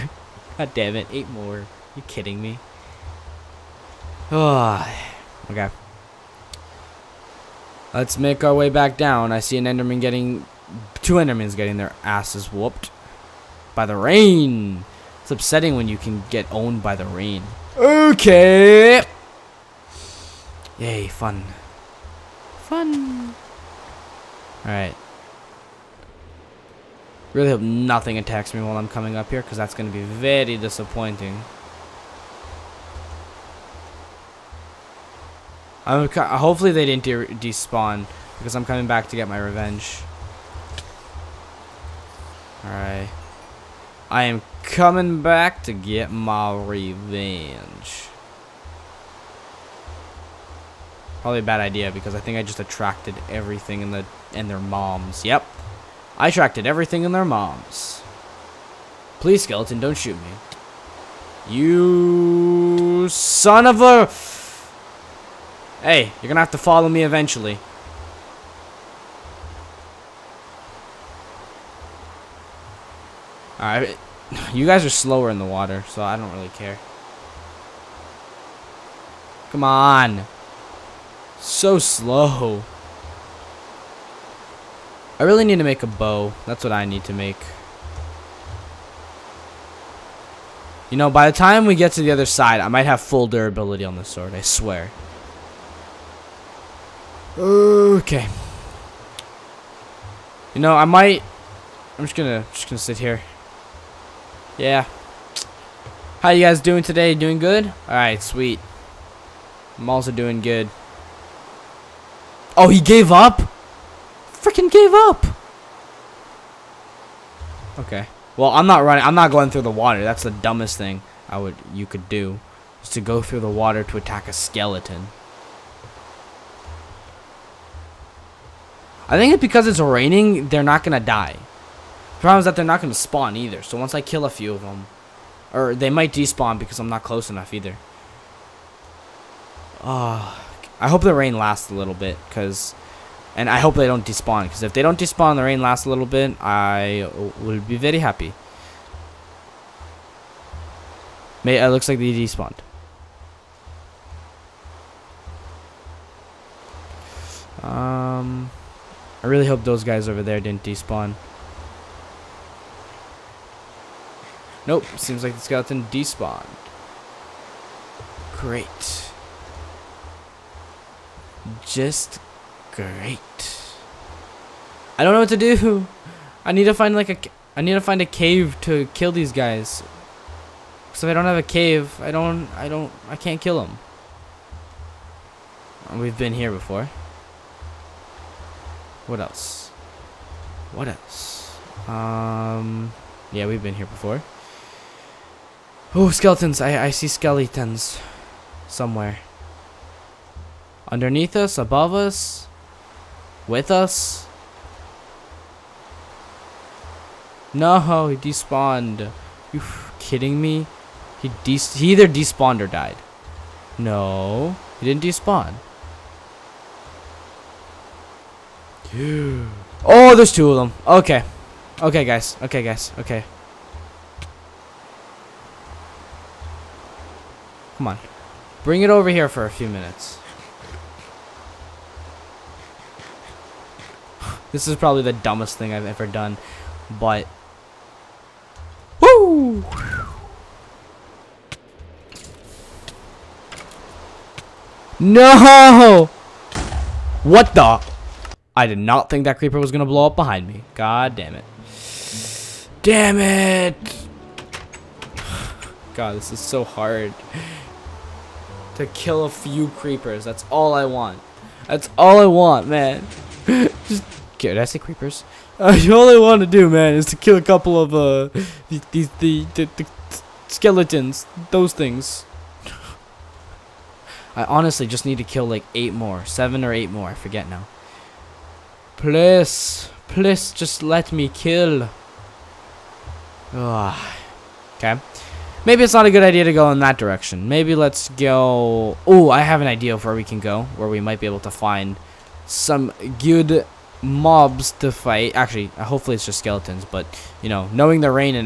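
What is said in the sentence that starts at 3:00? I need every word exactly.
So if I don't have a cave, I don't I don't I can't kill them.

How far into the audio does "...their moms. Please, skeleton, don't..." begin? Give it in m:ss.
0:57.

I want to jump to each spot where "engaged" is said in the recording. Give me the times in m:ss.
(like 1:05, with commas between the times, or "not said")
not said.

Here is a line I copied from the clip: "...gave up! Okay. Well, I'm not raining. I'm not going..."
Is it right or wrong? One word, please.
wrong.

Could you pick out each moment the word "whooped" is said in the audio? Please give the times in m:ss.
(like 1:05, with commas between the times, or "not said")
0:12.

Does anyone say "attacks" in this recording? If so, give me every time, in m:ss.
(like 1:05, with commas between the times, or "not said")
0:28, 2:03.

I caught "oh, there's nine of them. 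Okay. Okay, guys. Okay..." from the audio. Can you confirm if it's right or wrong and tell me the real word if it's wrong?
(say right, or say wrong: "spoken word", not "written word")
wrong: "two", not "nine".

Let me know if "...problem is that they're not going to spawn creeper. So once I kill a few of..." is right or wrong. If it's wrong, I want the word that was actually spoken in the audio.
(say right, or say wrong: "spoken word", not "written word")
wrong: "either", not "creeper".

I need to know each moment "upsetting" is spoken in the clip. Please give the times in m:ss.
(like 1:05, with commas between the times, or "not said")
0:15.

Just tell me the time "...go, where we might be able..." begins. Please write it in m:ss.
4:50.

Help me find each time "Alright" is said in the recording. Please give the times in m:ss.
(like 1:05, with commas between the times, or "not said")
0:24, 0:42, 1:13, 1:47.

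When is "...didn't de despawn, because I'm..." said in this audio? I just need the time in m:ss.
0:36.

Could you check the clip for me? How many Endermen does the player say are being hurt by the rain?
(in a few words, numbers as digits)
2.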